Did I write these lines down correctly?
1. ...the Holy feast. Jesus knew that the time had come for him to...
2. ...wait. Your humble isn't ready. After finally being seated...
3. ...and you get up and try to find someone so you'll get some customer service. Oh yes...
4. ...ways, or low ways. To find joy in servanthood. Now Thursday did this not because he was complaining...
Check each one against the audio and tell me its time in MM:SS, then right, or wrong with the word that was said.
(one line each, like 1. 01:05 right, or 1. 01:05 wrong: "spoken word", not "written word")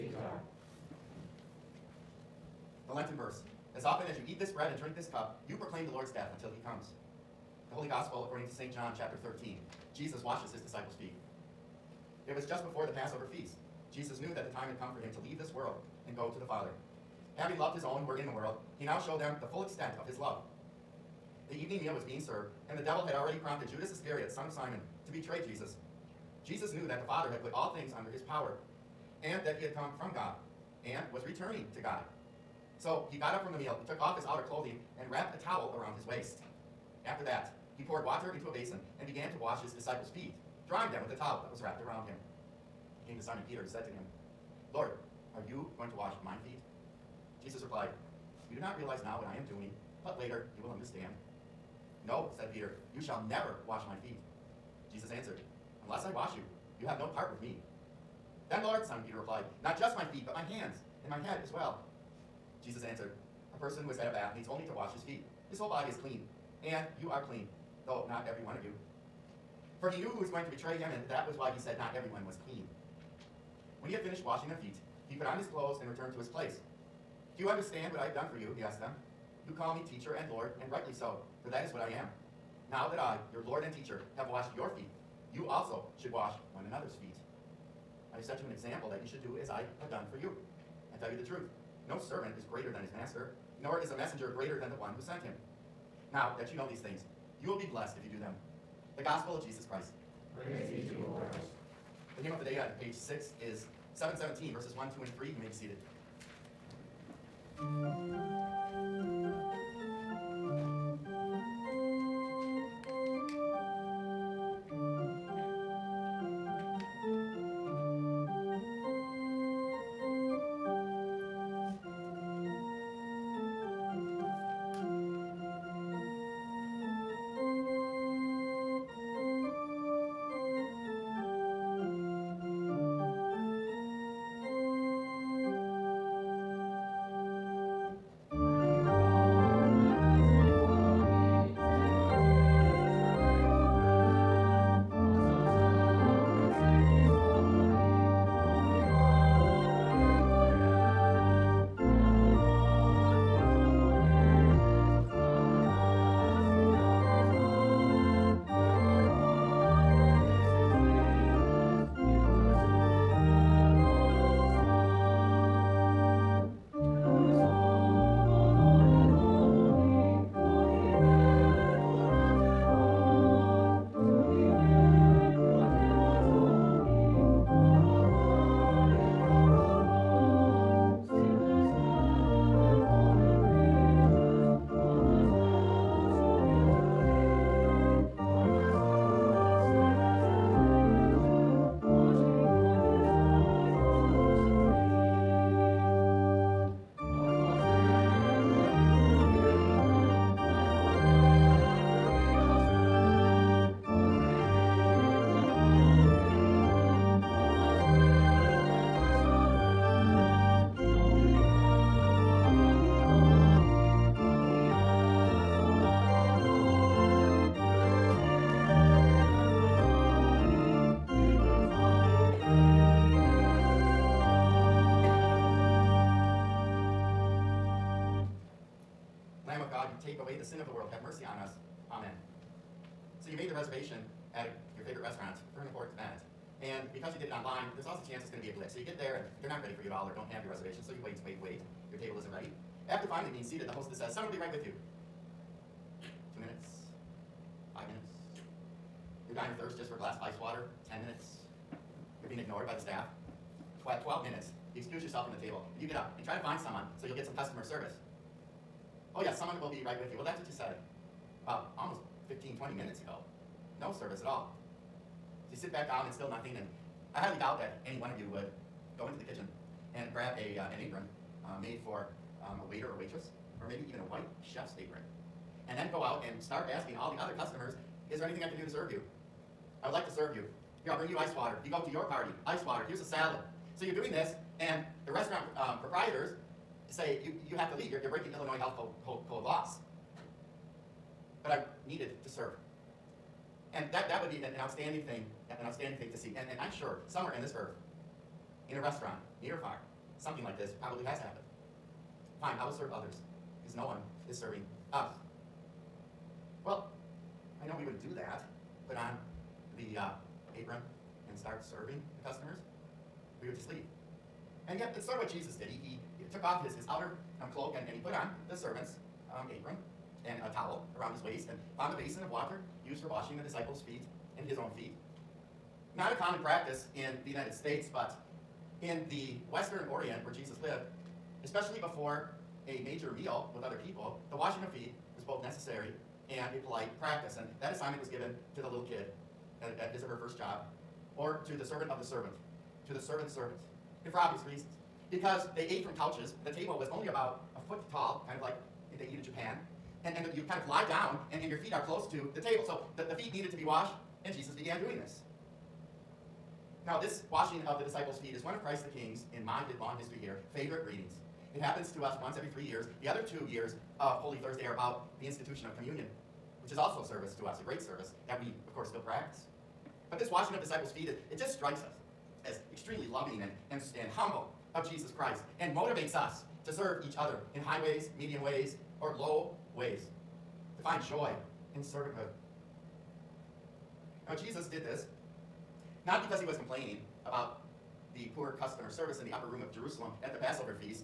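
1. 00:12 wrong: "Passover", not "Holy"
2. 04:01 wrong: "table", not "humble"
3. 04:15 right
4. 06:18 wrong: "Jesus", not "Thursday".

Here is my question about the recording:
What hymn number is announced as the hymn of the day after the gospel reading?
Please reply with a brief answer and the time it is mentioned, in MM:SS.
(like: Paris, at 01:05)
717, at 01:43.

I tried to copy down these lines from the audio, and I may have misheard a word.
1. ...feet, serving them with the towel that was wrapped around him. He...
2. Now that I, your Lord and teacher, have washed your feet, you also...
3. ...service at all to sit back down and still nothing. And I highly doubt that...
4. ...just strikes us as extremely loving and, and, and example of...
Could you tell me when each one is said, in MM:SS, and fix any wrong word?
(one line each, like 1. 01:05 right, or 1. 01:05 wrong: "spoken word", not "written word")
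1. 00:40 wrong: "drying", not "serving"
2. 01:22 right
3. 04:24 right
4. 06:11 wrong: "humble", not "example".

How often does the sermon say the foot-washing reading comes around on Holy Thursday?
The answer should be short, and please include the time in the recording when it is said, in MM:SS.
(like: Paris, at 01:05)
once every three years, at 06:02.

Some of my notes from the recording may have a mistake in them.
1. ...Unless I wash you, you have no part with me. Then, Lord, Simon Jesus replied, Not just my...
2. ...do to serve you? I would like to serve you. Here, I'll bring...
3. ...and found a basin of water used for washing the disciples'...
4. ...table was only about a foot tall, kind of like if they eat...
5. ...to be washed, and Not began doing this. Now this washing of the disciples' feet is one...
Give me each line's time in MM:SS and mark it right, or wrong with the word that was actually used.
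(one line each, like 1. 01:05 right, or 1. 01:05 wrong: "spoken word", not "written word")
1. 00:55 wrong: "Peter", not "Jesus"
2. 04:38 right
3. 05:21 right
4. 05:46 right
5. 05:53 wrong: "Jesus", not "Not".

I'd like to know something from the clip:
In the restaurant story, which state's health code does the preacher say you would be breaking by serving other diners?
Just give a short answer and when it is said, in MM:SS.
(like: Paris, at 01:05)
Illinois, at 04:48.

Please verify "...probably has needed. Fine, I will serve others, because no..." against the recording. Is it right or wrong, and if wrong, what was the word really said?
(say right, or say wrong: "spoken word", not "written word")
wrong: "happened", not "needed".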